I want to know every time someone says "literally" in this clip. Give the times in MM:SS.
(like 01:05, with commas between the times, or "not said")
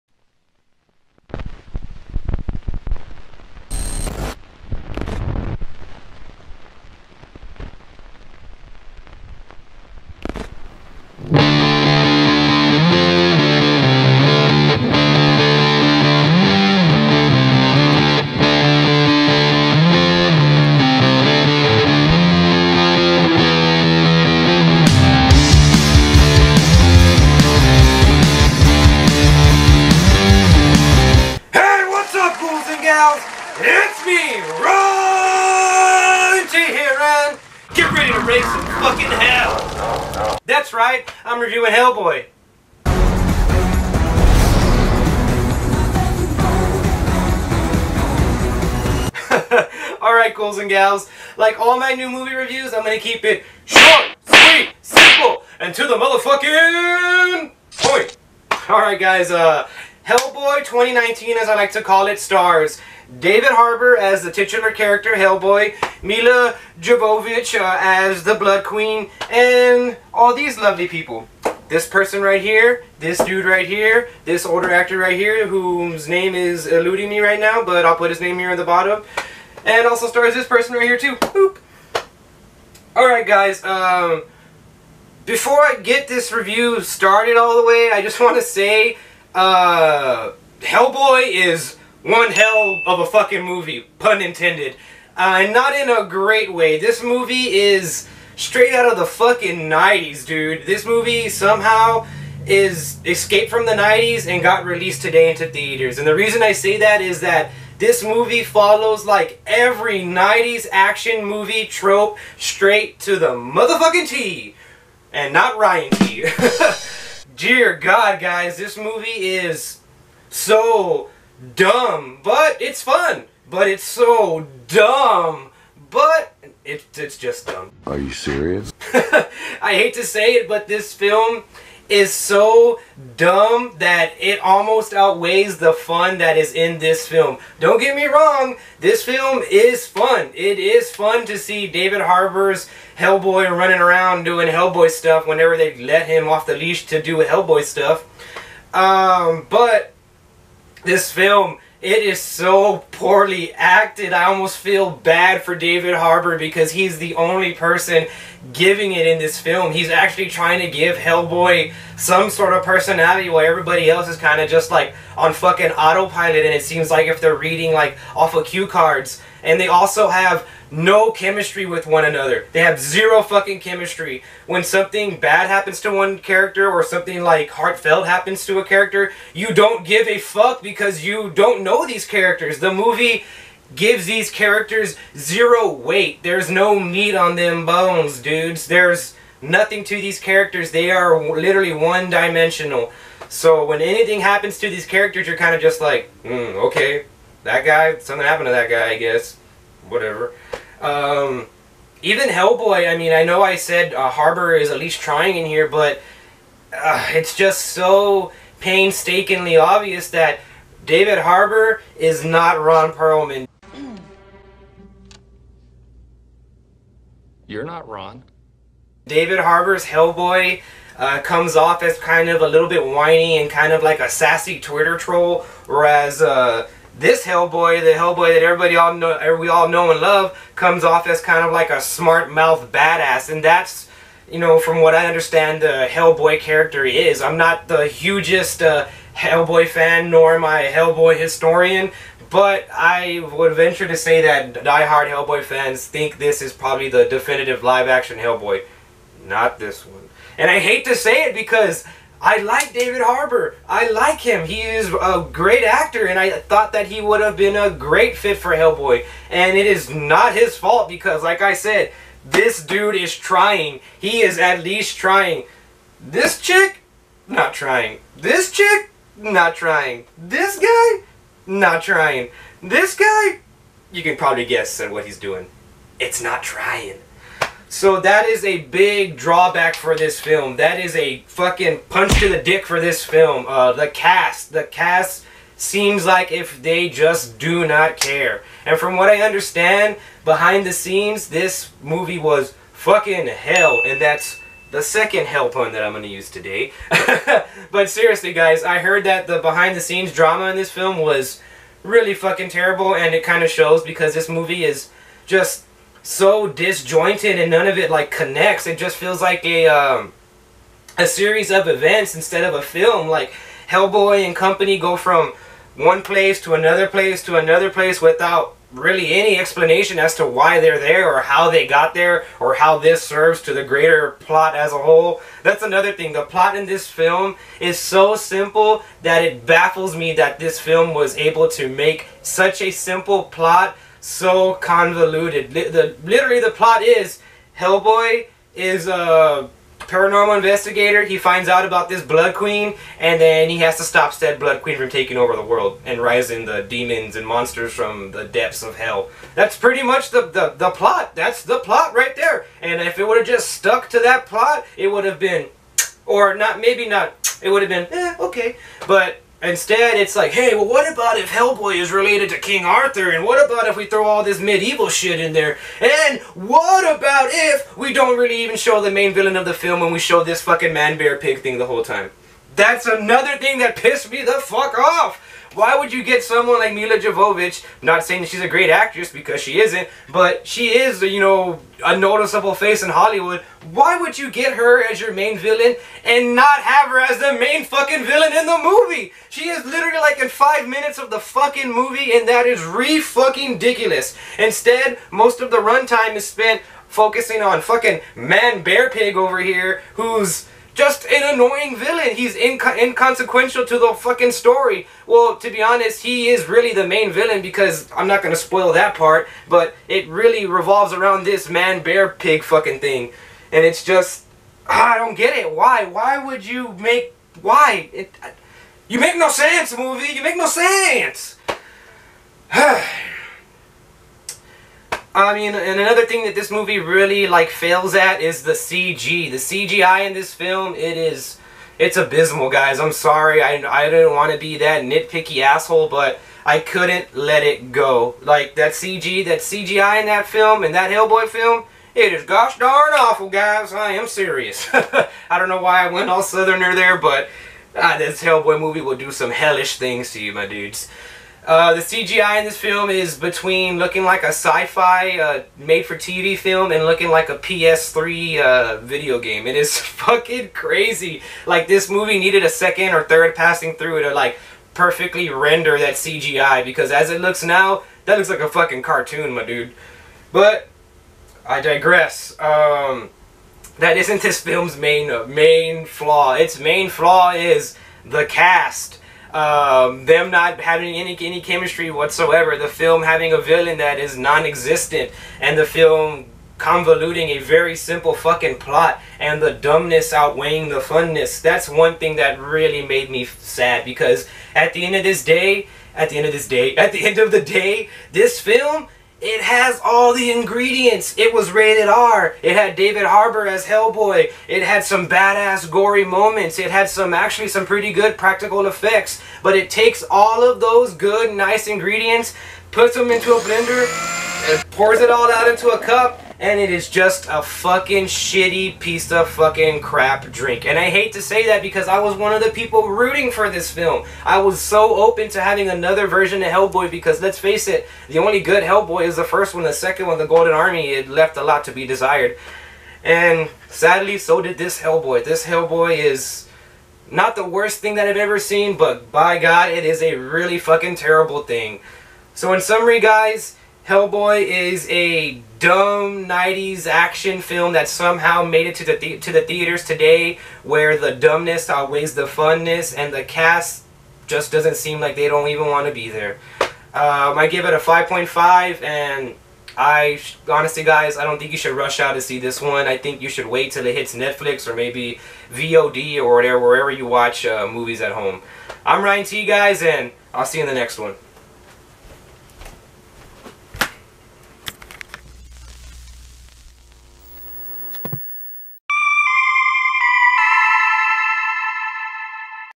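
03:11, 05:36, 06:29.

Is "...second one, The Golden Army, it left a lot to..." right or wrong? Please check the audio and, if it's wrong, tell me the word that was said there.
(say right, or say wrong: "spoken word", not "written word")
right.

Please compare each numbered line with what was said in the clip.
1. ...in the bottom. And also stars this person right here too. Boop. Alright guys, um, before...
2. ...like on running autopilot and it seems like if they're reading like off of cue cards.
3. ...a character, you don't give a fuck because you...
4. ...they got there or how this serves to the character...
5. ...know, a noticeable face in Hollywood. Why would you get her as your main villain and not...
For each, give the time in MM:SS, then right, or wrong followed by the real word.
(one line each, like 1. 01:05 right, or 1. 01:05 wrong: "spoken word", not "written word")
1. 01:18 right
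2. 02:44 wrong: "fucking", not "running"
3. 02:58 right
4. 05:21 wrong: "greater", not "character"
5. 06:21 right.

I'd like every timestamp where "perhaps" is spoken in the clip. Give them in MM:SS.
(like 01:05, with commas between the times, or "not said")
not said.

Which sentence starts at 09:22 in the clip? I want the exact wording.
I think you should wait till it hits Netflix or maybe VOD or whatever wherever you watch uh, movies at home.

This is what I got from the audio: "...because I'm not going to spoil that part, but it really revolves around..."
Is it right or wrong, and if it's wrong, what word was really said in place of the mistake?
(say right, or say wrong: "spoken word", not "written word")
right.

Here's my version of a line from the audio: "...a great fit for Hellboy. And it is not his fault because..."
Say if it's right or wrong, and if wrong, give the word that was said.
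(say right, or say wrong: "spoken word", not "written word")
right.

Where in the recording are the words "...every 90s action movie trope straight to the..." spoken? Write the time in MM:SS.
01:49.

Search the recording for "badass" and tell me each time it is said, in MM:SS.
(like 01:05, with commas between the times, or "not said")
03:52, 08:25.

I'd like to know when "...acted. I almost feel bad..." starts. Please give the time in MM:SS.
02:33.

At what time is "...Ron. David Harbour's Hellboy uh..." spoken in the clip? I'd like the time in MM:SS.
03:37.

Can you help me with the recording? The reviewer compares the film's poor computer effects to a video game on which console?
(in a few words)
PS3.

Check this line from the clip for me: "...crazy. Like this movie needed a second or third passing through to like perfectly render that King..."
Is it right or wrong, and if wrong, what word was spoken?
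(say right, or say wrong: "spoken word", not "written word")
wrong: "CGI", not "King".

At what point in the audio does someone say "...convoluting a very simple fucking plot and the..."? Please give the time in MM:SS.
08:06.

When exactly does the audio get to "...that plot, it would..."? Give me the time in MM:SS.
05:53.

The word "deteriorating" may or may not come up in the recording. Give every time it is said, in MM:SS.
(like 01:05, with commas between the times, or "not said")
not said.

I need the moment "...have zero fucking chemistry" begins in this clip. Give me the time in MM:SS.
02:52.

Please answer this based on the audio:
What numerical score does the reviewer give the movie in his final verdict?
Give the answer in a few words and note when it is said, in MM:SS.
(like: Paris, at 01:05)
5.5, at 09:17.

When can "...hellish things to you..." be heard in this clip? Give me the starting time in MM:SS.
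07:29.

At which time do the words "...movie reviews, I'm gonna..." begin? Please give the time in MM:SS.
00:52.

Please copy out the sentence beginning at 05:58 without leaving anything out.
But Instead, it's like, hey, well, what about if Hellboy is related to King Arthur?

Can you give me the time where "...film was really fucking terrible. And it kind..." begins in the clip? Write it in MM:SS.
05:00.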